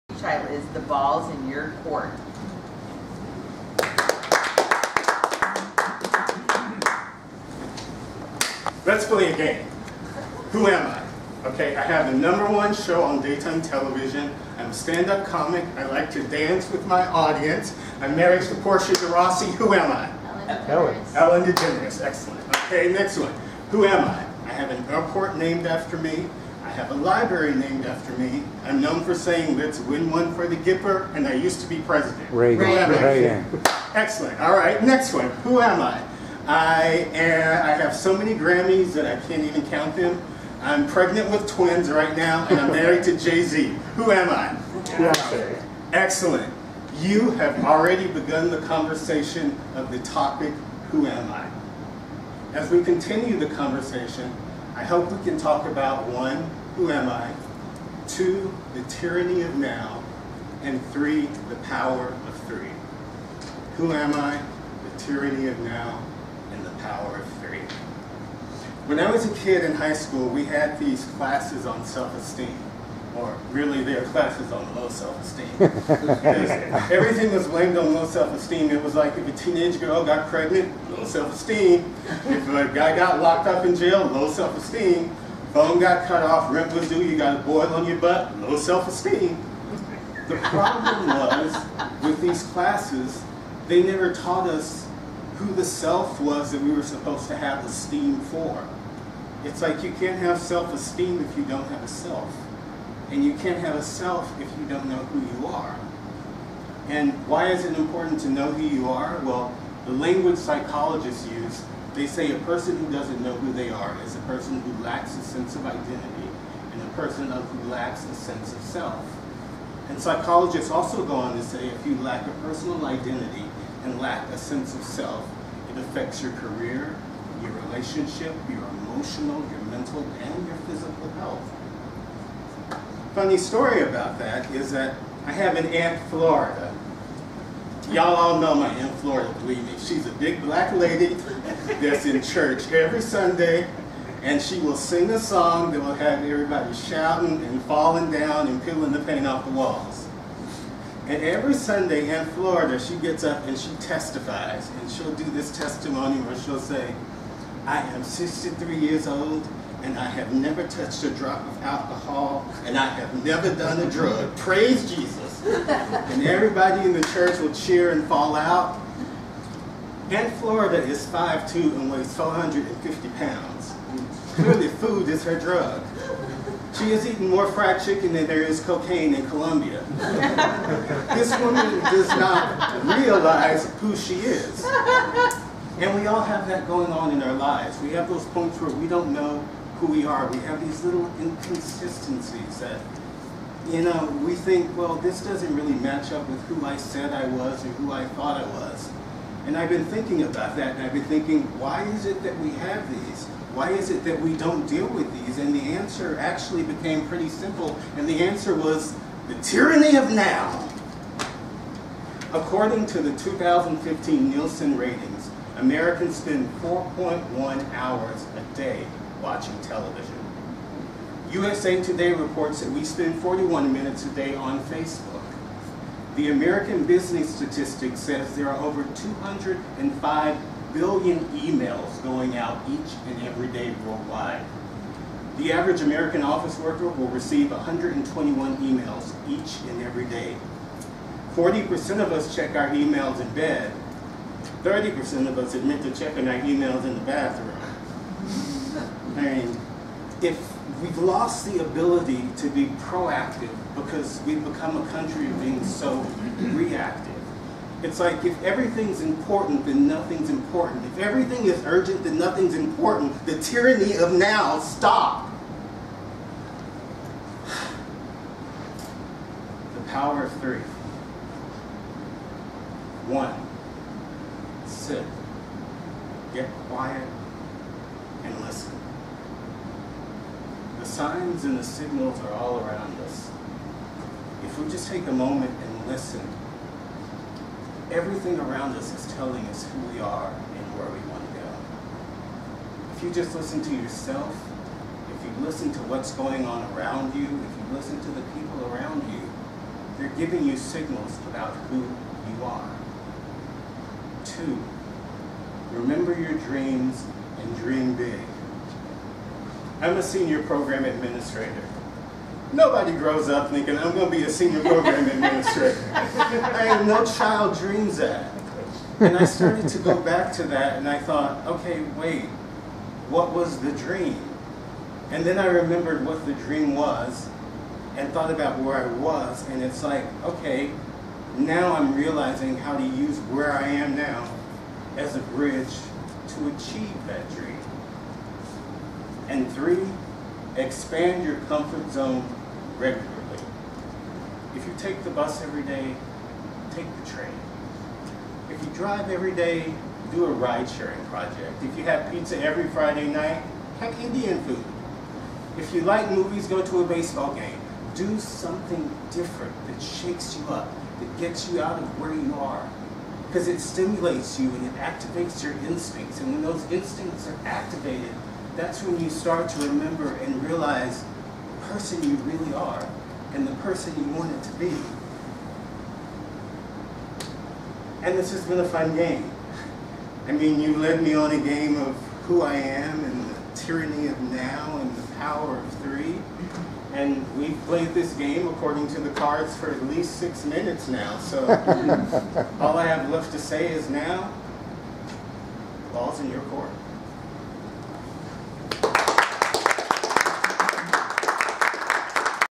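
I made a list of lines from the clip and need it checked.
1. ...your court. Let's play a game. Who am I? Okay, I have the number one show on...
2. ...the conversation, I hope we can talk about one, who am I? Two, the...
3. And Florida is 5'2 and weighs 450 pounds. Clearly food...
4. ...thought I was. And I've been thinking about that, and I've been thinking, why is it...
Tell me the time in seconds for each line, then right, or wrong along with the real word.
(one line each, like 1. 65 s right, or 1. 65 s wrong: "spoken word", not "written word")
1. 1 s right
2. 53 s right
3. 170 s right
4. 198 s right.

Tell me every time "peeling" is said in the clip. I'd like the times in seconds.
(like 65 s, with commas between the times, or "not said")
148 s.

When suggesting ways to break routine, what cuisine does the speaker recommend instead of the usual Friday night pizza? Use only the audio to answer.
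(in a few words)
Indian food.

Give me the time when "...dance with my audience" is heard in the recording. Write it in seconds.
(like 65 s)
16 s.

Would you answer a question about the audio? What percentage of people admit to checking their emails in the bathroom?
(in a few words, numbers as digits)
30%.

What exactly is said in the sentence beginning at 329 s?
And it's like, okay, now I'm realizing how to use where I am now as a bridge to achieve that dream.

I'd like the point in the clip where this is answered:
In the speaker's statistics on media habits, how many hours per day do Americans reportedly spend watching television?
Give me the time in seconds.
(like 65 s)
216 s.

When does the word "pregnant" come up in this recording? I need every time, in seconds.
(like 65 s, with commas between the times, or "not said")
40 s, 80 s.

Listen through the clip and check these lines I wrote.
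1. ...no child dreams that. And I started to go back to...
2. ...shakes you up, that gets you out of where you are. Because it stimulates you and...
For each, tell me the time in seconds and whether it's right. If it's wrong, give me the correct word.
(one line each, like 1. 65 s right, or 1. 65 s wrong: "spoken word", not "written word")
1. 316 s right
2. 359 s right.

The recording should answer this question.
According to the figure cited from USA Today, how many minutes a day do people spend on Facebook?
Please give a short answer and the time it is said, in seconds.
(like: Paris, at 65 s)
41 minutes, at 223 s.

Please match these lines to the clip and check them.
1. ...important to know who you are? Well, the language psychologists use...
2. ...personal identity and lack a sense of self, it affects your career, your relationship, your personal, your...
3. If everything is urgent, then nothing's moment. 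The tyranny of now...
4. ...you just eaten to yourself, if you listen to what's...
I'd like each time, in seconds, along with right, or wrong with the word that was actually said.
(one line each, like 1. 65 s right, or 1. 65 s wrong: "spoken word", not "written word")
1. 107 s right
2. 122 s wrong: "emotional", not "personal"
3. 260 s wrong: "important", not "moment"
4. 293 s wrong: "listen", not "eaten".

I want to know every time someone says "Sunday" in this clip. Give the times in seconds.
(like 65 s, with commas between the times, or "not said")
143 s, 151 s.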